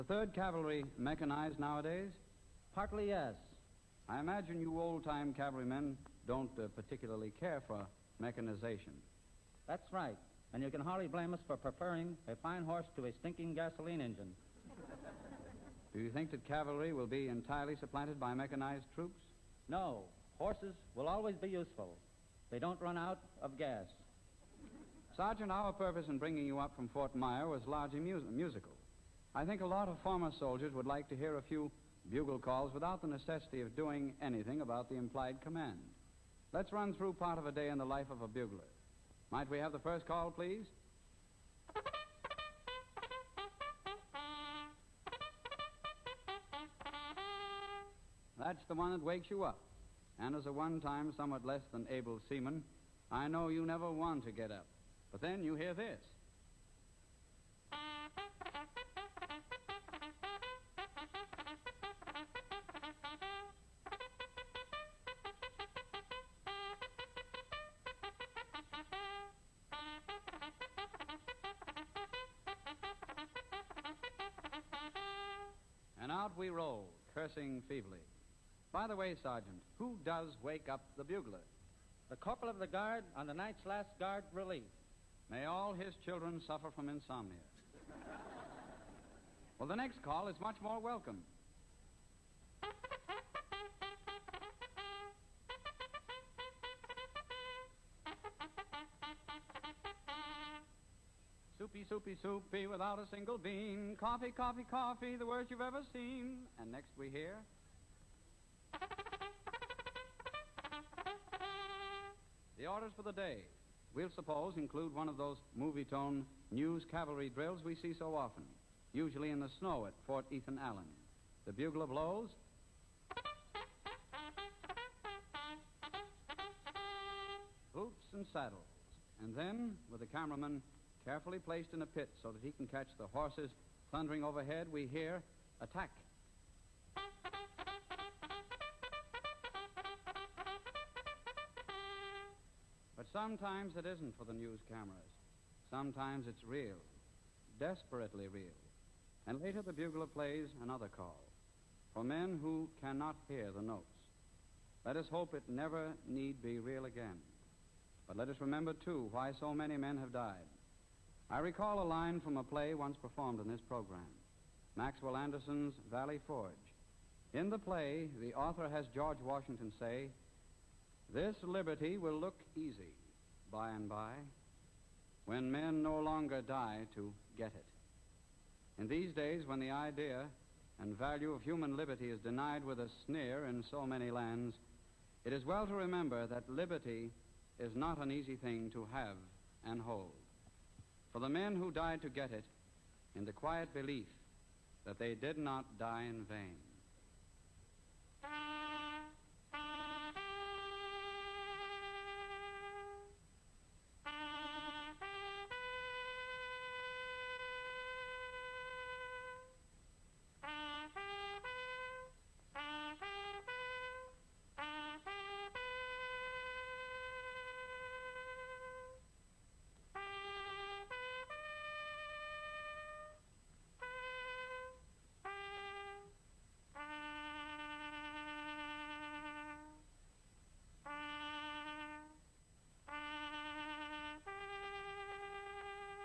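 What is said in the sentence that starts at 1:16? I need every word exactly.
And out we roll, cursing feebly.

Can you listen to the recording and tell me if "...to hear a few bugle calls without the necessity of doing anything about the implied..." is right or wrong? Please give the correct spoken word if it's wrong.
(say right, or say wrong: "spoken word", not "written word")
right.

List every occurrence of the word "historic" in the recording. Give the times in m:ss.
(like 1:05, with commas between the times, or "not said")
not said.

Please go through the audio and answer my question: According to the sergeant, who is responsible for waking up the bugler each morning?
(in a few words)
The corporal of the guard.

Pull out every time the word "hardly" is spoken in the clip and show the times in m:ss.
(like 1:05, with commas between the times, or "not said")
0:10.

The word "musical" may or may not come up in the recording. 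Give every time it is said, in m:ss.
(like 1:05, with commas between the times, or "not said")
0:27.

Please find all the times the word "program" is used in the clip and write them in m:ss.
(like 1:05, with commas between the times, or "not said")
2:43.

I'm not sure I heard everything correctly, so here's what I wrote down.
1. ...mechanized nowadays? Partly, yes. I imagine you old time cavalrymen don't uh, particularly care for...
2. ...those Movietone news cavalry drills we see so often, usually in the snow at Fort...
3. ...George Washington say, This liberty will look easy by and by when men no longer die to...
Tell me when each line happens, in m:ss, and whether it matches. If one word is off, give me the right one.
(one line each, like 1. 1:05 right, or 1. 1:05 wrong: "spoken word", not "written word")
1. 0:00 right
2. 1:55 right
3. 2:48 right.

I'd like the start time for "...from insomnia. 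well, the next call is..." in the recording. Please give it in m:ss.
1:26.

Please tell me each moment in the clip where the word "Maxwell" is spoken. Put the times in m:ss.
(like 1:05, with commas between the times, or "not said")
2:44.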